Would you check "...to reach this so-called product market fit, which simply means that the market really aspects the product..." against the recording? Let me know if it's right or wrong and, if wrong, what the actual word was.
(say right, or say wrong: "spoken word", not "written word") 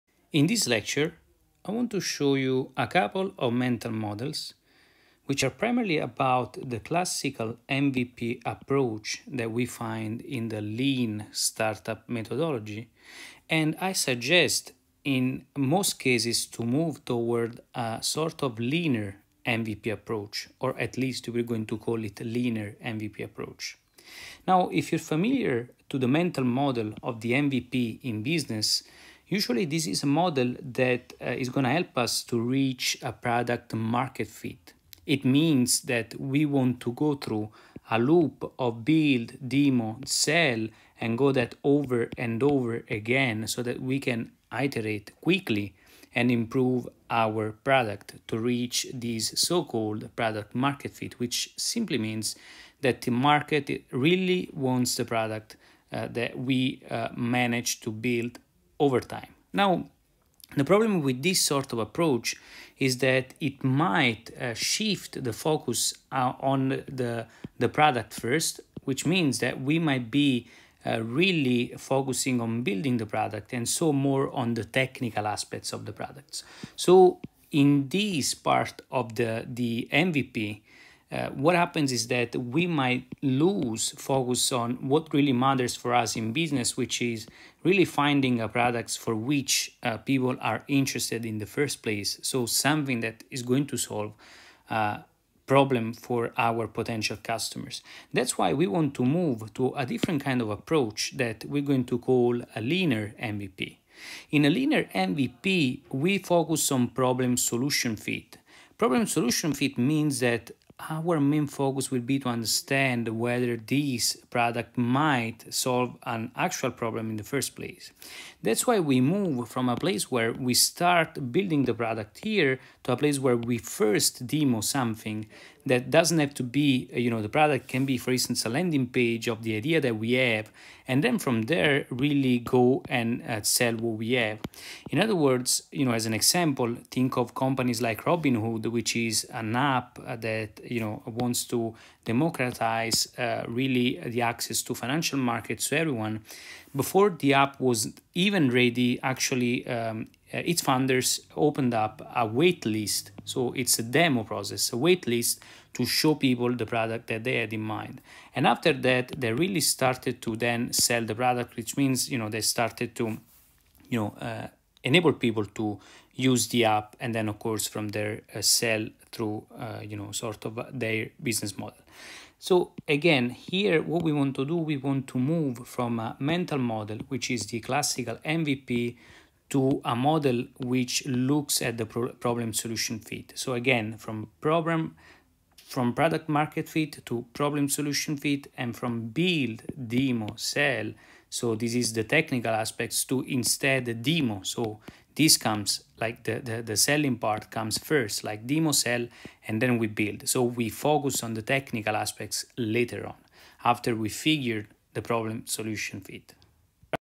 wrong: "wants", not "aspects".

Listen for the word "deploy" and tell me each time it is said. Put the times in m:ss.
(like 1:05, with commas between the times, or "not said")
not said.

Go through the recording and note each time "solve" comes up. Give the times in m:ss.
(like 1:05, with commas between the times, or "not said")
1:33, 1:55.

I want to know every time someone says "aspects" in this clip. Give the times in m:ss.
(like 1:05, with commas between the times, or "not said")
1:15, 3:12, 3:21.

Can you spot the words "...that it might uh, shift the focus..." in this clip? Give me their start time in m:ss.
1:02.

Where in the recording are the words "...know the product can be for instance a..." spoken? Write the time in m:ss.
2:07.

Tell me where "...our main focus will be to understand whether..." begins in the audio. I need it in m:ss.
1:50.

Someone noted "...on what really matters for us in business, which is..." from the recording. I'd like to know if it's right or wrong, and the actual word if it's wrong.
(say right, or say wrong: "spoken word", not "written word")
right.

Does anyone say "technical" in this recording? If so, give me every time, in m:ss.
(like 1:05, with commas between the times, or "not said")
1:14, 3:12, 3:21.